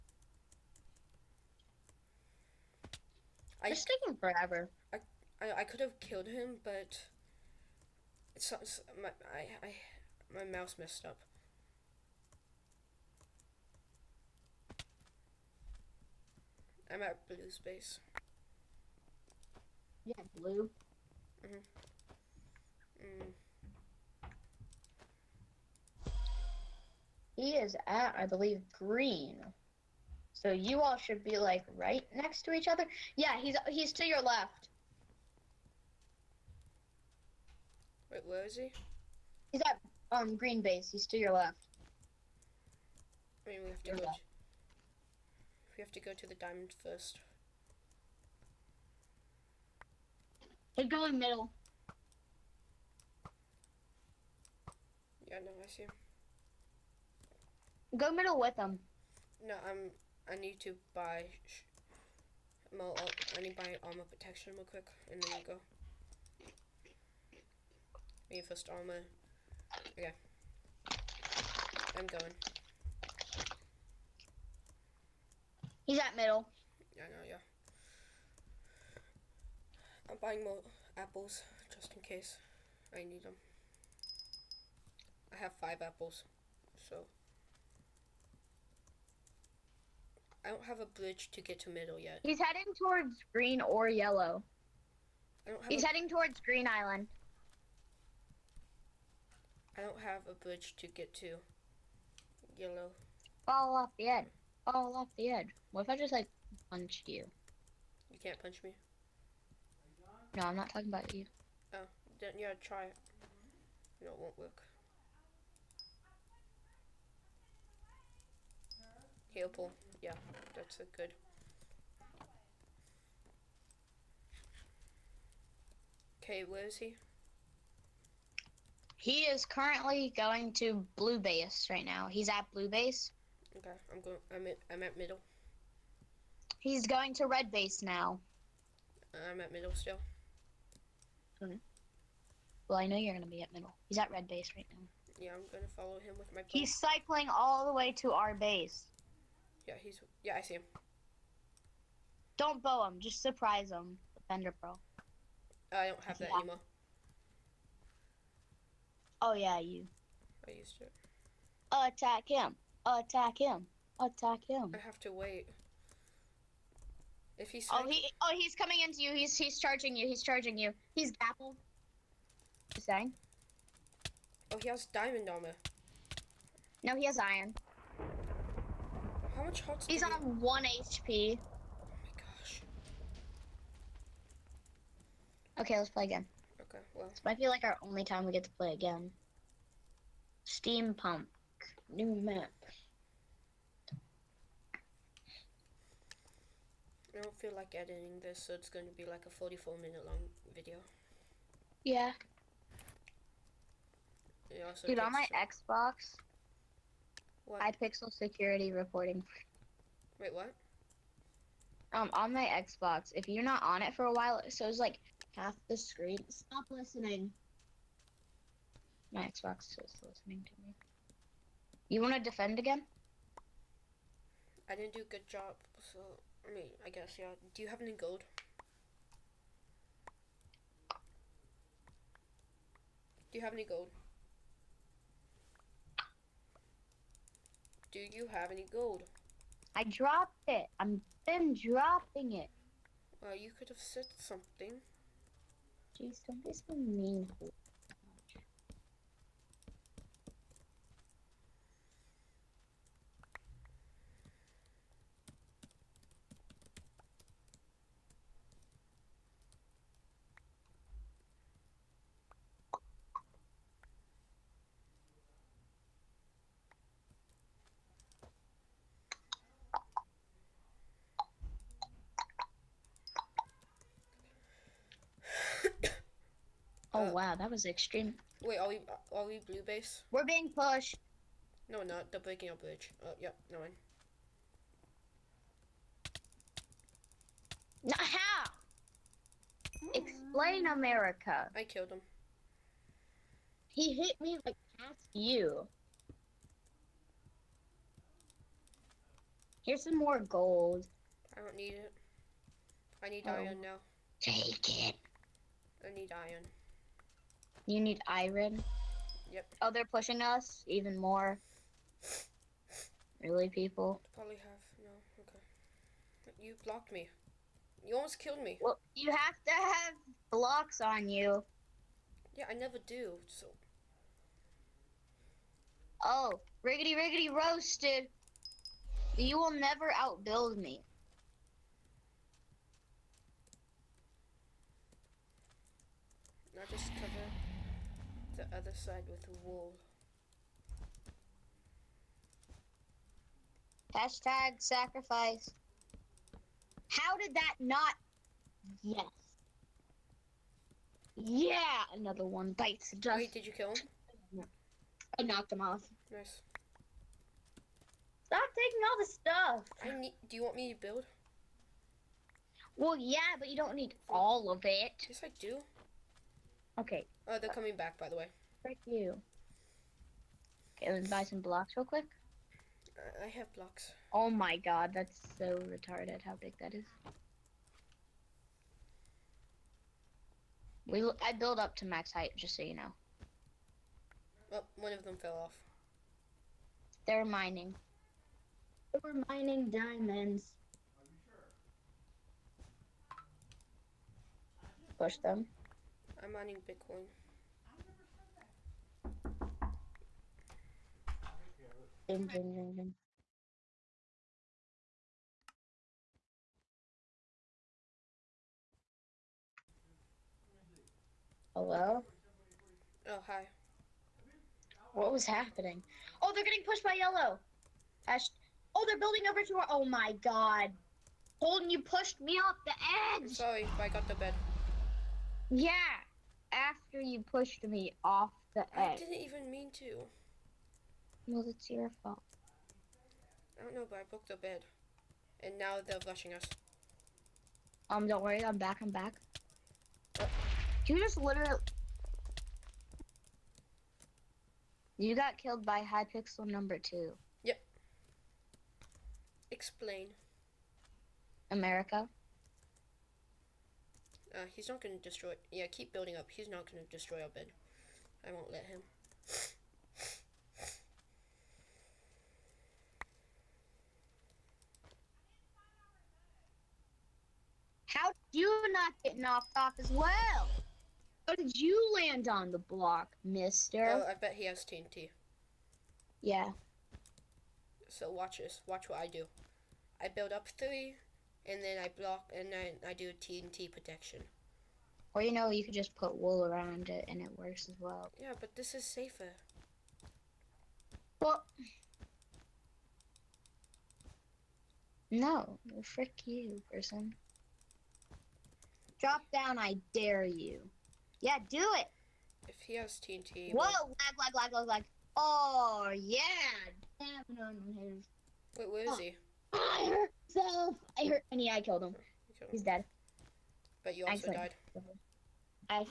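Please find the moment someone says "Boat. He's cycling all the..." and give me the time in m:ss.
2:26.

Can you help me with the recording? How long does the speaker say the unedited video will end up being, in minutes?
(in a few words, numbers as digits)
44.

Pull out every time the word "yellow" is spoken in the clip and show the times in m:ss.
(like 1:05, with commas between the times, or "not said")
1:33, 1:42, 6:56.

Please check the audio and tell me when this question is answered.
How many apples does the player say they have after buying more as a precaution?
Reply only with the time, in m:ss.
1:25.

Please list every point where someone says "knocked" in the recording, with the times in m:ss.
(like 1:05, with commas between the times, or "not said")
5:55, 7:49.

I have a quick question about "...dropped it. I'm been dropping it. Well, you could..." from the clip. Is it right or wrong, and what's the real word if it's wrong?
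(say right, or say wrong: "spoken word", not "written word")
right.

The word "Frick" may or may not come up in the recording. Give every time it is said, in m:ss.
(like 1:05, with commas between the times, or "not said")
6:08, 8:15.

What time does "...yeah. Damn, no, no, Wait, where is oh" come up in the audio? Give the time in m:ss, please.
8:25.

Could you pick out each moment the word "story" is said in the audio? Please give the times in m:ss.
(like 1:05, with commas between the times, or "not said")
not said.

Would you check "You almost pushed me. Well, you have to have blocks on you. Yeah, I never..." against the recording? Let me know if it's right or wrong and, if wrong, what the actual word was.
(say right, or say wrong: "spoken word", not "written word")
wrong: "killed", not "pushed".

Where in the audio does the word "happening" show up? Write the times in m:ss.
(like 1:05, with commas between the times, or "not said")
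6:55.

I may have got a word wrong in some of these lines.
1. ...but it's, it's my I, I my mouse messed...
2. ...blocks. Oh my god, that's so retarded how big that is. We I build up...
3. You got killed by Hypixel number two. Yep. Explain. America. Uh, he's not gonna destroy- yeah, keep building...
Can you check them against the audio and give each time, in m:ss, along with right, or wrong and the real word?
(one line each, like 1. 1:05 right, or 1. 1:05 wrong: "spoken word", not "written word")
1. 0:06 right
2. 6:13 right
3. 7:24 right.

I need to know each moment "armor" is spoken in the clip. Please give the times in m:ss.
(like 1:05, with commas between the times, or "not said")
1:03, 1:08, 2:55.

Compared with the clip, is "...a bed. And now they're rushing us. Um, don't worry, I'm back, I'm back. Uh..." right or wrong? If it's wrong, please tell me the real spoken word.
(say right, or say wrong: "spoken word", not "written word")
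right.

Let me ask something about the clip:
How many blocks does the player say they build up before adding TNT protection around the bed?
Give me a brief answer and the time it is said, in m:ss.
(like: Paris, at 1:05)
3, at 8:00.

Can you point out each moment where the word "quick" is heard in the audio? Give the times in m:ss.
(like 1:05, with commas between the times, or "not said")
1:04, 6:11.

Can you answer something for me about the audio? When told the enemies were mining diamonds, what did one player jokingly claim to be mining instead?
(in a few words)
Bitcoin.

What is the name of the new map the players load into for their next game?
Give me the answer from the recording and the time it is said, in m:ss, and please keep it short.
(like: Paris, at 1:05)
Steampunk, at 3:10.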